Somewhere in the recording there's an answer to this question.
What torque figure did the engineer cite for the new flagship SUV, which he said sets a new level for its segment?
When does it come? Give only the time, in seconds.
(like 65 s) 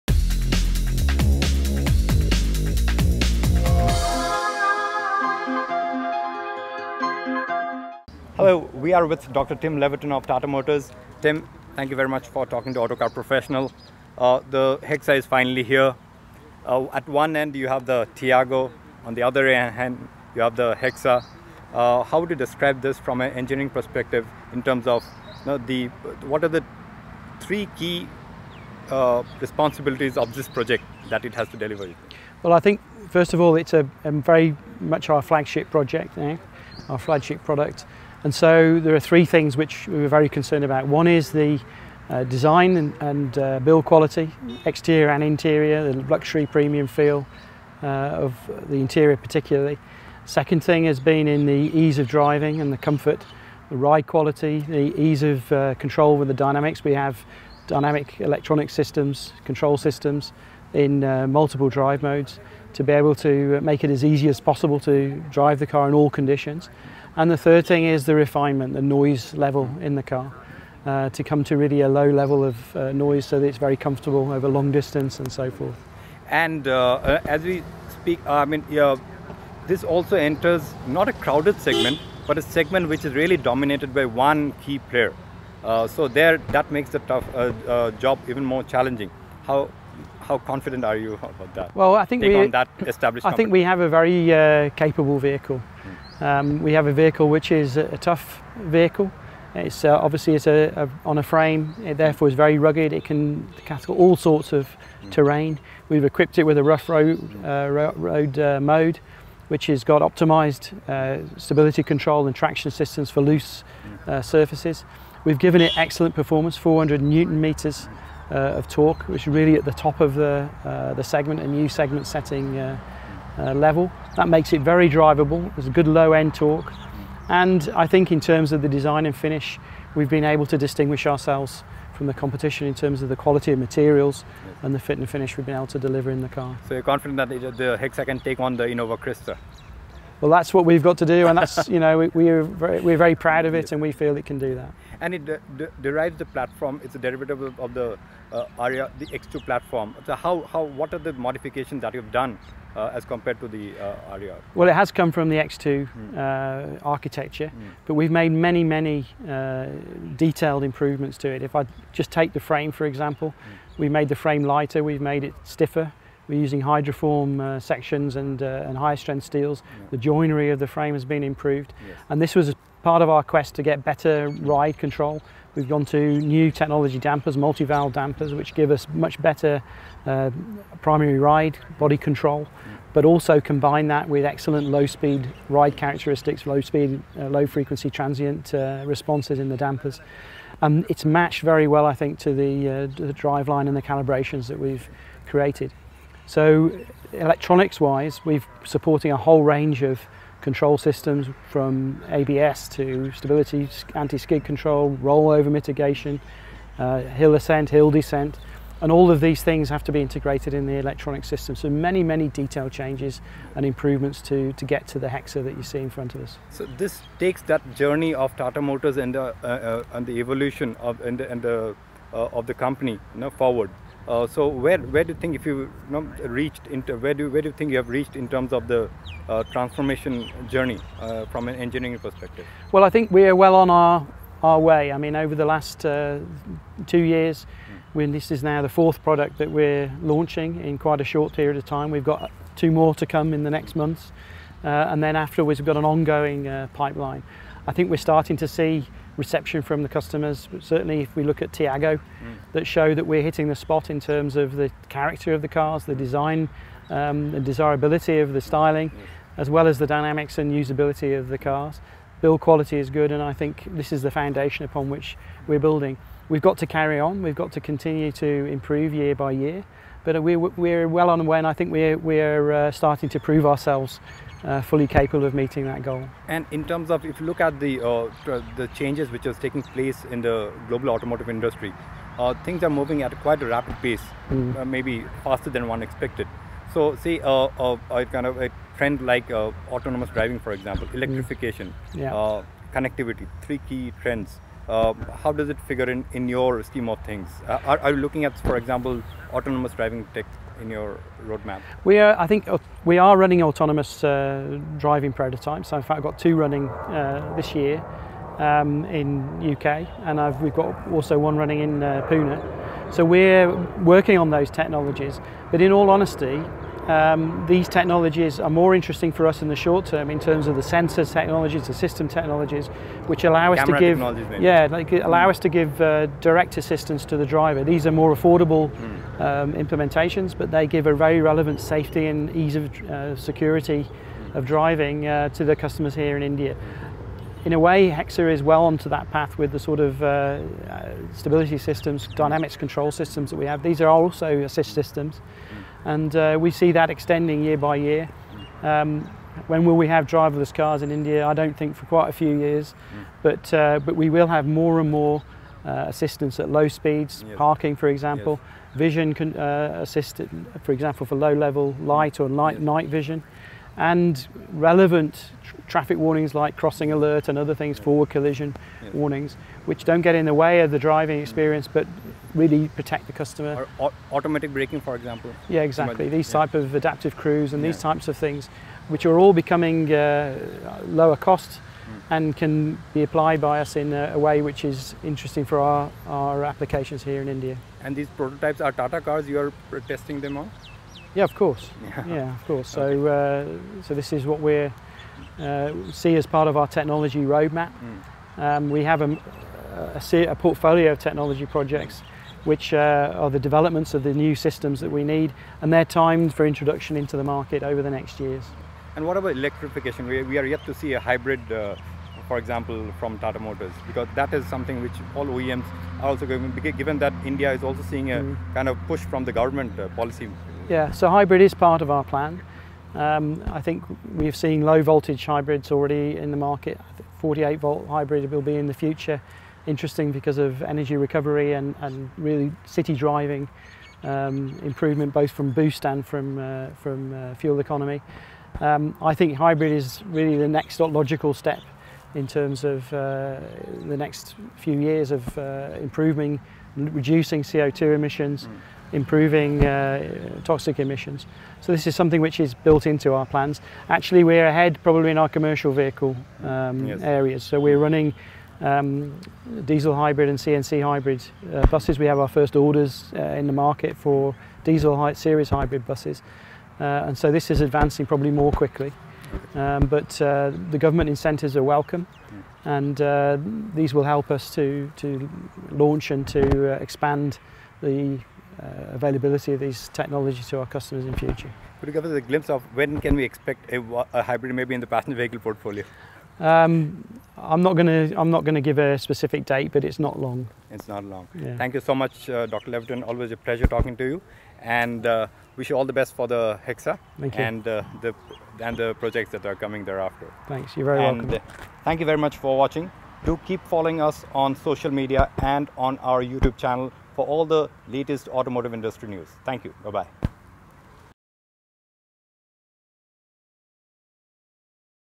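116 s.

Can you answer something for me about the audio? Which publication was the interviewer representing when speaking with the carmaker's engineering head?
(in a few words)
AutoCar Professional.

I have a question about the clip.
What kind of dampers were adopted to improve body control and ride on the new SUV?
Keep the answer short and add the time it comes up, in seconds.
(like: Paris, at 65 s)
multi-valve dampers, at 177 s.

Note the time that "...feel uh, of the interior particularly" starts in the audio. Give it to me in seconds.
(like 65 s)
46 s.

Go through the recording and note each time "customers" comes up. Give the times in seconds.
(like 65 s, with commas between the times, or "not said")
249 s, 335 s, 373 s, 480 s.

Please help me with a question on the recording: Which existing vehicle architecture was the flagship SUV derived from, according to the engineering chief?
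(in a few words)
X2.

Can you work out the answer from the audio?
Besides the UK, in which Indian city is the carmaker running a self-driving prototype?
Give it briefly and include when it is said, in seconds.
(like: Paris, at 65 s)
Pune, at 312 s.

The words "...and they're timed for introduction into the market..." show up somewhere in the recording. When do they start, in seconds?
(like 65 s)
405 s.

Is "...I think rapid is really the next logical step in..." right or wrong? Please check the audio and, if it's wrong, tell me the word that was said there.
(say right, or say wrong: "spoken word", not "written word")
wrong: "hybrid", not "rapid".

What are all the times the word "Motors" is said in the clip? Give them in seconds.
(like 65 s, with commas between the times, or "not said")
10 s, 218 s, 413 s.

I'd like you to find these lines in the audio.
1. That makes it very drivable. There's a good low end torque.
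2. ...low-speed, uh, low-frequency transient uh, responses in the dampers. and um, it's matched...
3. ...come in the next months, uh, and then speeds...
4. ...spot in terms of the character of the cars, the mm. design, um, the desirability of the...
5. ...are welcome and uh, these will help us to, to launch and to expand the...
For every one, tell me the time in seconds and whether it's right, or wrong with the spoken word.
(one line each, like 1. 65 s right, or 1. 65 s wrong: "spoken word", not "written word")
1. 124 s right
2. 186 s right
3. 243 s wrong: "afterwards", not "speeds"
4. 253 s right
5. 471 s right.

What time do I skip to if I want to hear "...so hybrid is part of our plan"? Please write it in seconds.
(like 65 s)
420 s.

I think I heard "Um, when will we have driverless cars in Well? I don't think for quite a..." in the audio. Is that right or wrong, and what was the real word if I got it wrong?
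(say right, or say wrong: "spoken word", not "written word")
wrong: "India", not "Well".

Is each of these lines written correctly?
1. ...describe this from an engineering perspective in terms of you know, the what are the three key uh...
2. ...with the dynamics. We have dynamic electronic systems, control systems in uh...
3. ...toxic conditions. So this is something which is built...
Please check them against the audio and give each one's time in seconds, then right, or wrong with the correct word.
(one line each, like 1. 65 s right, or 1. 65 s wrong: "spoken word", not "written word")
1. 22 s right
2. 56 s right
3. 450 s wrong: "emissions", not "conditions".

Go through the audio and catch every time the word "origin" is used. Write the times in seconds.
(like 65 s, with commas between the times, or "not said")
not said.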